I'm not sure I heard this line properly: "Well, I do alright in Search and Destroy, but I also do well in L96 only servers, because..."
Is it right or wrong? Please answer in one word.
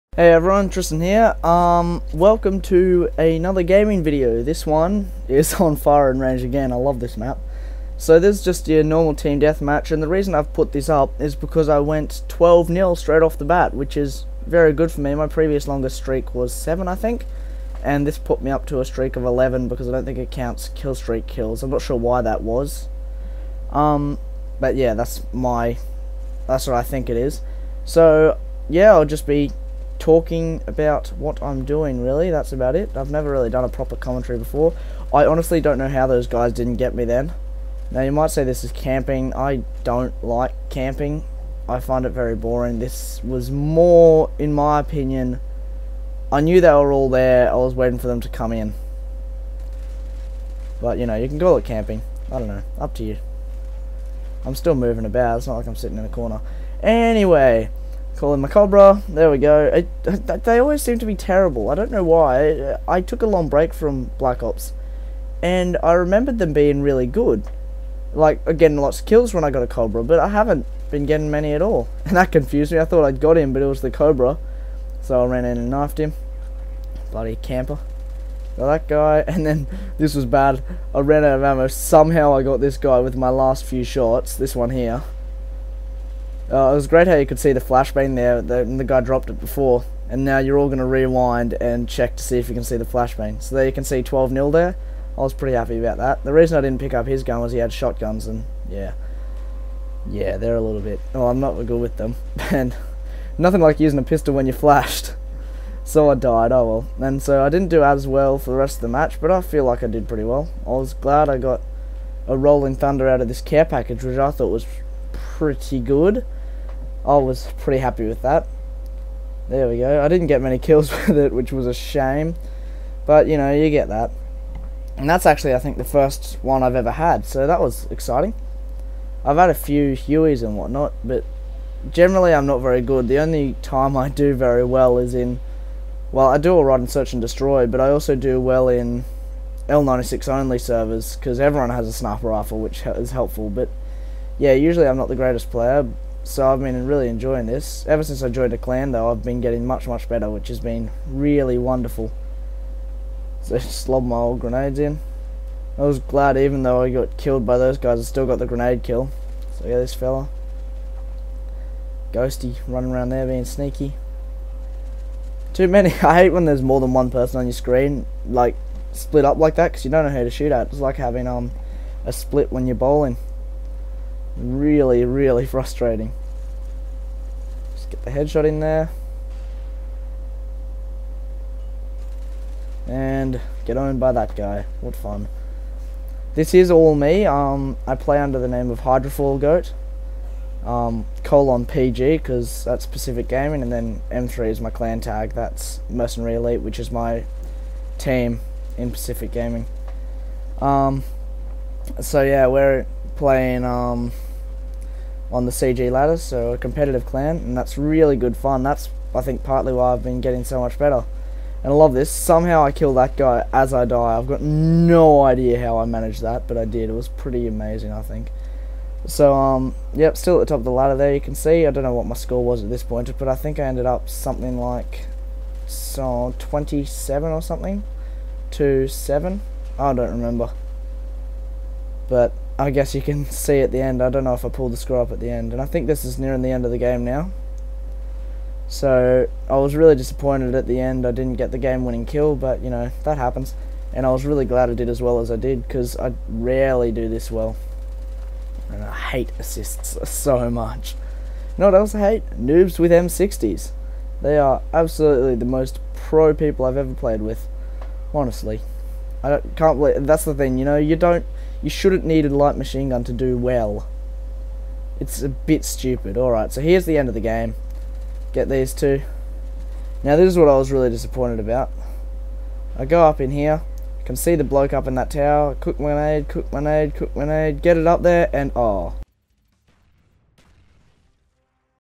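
right.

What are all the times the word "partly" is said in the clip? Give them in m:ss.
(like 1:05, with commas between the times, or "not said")
3:29.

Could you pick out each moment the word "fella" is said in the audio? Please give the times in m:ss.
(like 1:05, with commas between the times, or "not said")
2:39.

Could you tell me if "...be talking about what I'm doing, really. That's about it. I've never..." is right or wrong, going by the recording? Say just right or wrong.
right.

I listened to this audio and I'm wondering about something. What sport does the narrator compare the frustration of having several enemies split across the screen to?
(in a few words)
bowling.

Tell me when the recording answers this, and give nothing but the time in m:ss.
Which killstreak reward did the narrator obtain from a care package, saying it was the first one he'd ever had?
1:52.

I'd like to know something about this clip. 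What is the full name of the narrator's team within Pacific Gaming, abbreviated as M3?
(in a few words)
Mercenary Elite.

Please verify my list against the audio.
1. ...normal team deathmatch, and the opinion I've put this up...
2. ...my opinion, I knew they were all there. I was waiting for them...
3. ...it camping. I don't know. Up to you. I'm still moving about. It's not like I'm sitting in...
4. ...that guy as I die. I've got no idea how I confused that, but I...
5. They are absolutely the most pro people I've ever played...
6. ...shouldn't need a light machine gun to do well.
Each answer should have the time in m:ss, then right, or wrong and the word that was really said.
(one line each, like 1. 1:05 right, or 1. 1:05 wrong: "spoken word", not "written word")
1. 0:08 wrong: "reason", not "opinion"
2. 0:44 right
3. 0:51 right
4. 3:32 wrong: "managed", not "confused"
5. 4:14 right
6. 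4:21 right.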